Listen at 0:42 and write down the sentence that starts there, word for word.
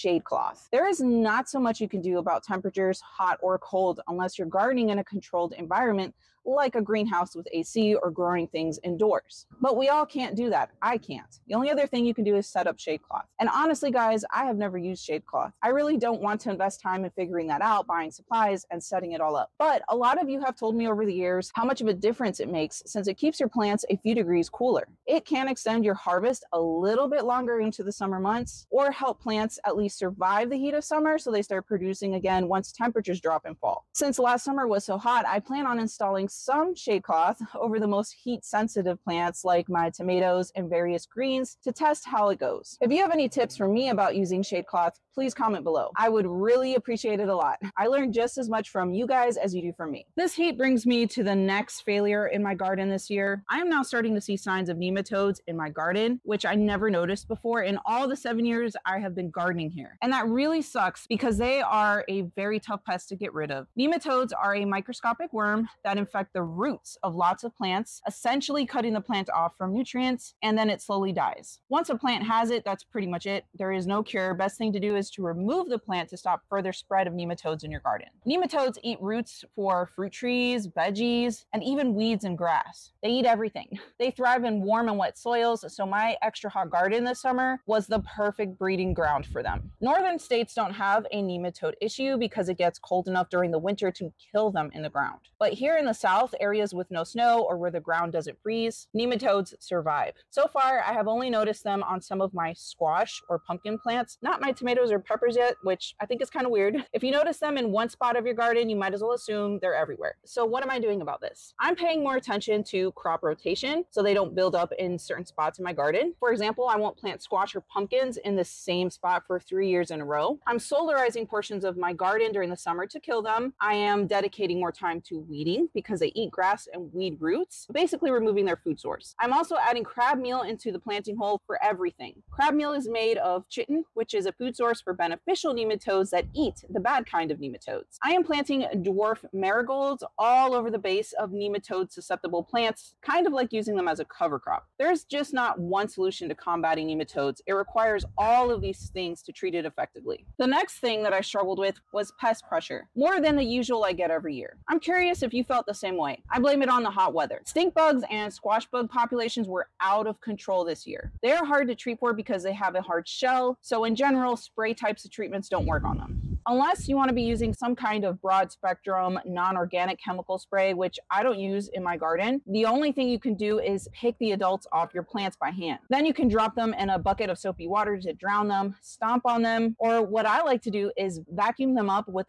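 If you have any tips for me about using shade cloth, please comment below.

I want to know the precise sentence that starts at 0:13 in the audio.
And honestly, guys, I have never used shade cloth.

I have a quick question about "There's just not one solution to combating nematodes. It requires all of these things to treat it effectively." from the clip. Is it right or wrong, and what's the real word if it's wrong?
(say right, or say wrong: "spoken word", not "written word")
right.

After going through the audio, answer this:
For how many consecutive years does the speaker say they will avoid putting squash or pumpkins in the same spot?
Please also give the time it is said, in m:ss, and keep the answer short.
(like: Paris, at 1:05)
3, at 1:59.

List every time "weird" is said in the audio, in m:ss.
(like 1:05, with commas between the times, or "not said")
1:46.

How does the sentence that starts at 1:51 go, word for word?
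I'm paying more attention to crop rotation so they don't build up in certain spots in my garden.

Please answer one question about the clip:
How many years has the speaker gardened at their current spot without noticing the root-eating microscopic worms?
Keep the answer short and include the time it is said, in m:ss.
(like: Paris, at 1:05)
7, at 0:58.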